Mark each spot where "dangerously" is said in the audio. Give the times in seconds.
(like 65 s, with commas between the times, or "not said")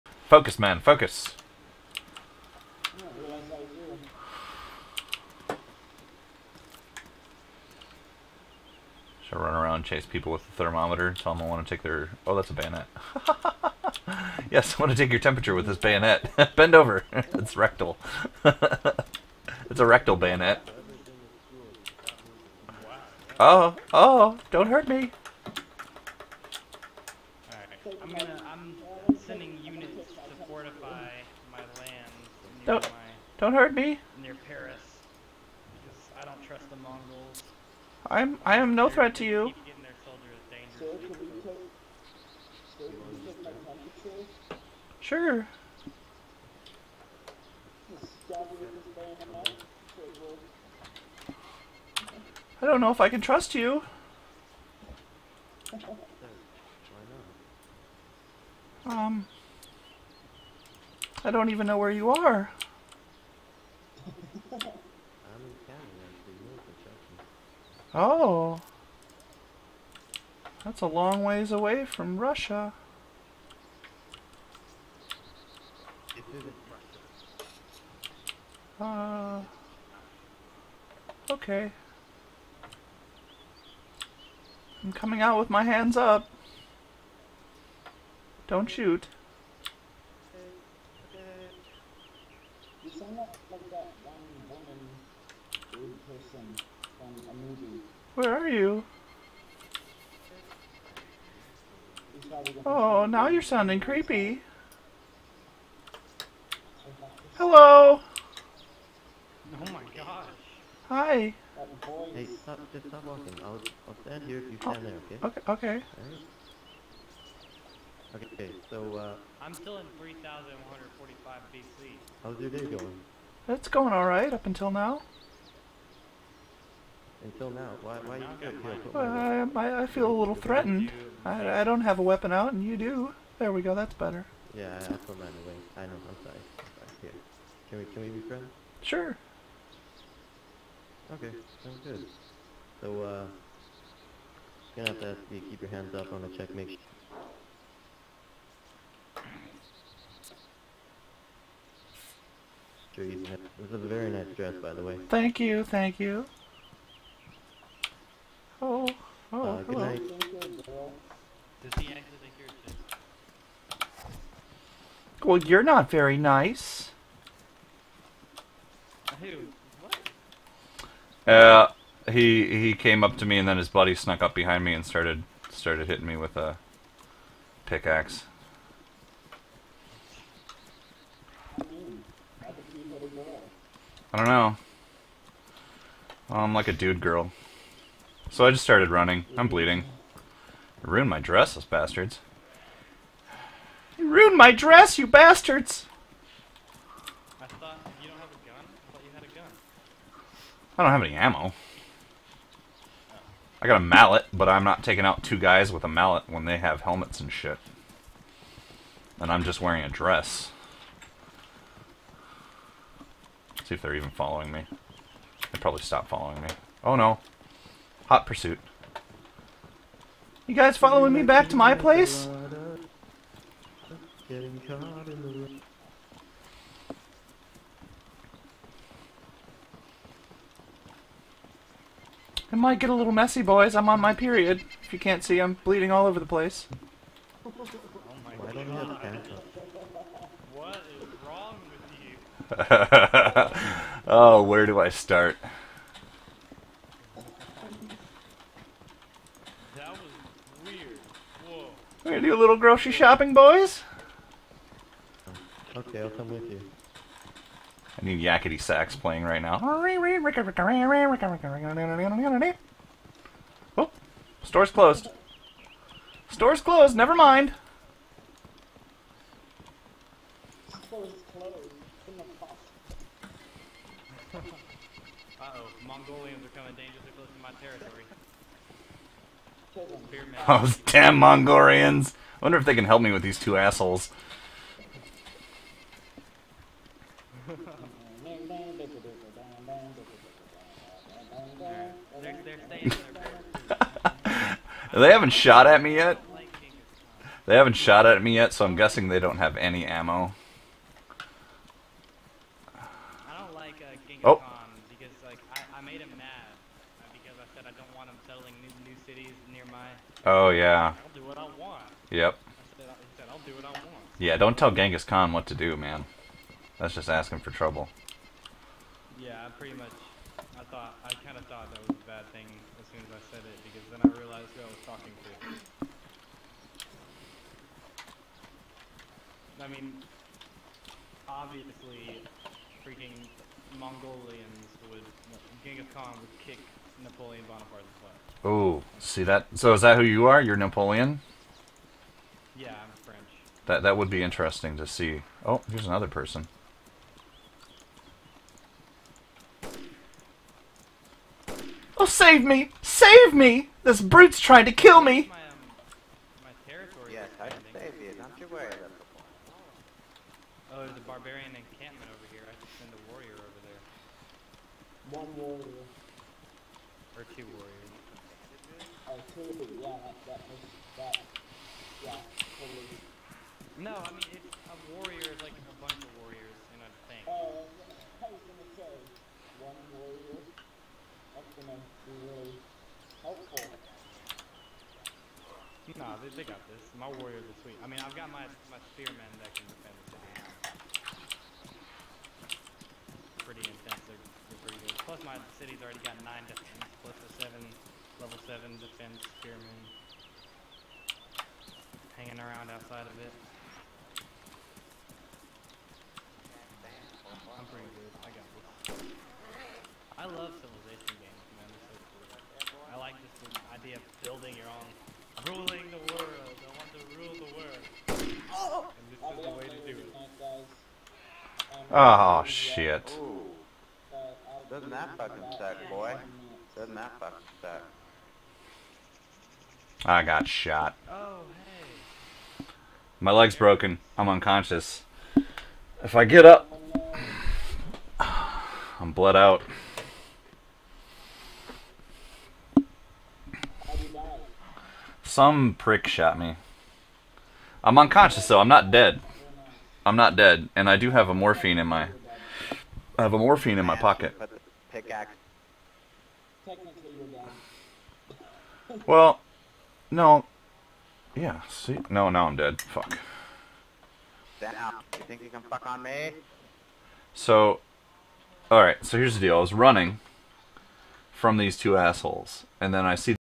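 276 s.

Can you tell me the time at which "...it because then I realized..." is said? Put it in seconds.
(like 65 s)
323 s.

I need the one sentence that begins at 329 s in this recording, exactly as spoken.
I mean, obviously, freaking Mongolians would Genghis Khan would kick Napoleon Bonaparte's butt.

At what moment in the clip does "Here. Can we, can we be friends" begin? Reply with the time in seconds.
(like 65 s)
137 s.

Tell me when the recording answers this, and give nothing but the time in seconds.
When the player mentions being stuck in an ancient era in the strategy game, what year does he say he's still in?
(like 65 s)
119 s.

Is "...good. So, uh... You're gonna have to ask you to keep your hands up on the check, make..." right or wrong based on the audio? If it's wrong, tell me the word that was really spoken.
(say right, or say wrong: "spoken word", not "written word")
right.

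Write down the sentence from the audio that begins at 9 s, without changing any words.
Should I run around chase people with the thermometer?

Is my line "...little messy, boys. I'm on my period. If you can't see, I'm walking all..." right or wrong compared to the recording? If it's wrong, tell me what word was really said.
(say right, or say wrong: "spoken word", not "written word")
wrong: "bleeding", not "walking".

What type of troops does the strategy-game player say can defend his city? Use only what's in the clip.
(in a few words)
Spearmen.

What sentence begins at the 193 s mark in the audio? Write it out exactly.
You ruined my dress, you bastards!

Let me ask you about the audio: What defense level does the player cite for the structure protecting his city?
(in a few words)
7.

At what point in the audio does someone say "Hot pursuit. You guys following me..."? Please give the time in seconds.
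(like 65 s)
218 s.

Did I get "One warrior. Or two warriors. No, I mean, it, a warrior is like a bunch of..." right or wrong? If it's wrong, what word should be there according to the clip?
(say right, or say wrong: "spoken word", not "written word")
right.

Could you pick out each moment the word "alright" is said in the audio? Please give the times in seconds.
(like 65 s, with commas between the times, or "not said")
123 s, 468 s.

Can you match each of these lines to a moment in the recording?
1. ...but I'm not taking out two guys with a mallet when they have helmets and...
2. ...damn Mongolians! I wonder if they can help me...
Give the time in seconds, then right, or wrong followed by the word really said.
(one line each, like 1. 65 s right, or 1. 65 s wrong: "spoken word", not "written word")
1. 204 s right
2. 280 s right.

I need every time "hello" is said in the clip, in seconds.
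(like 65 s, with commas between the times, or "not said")
107 s, 159 s.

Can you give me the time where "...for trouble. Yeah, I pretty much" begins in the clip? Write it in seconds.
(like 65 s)
317 s.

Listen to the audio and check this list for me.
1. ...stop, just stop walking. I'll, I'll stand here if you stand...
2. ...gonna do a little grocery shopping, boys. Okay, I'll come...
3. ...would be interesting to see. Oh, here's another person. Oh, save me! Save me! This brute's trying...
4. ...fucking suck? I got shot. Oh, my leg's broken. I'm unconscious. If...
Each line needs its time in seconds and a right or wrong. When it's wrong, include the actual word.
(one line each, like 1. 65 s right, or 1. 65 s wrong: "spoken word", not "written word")
1. 112 s right
2. 252 s right
3. 343 s right
4. 427 s right.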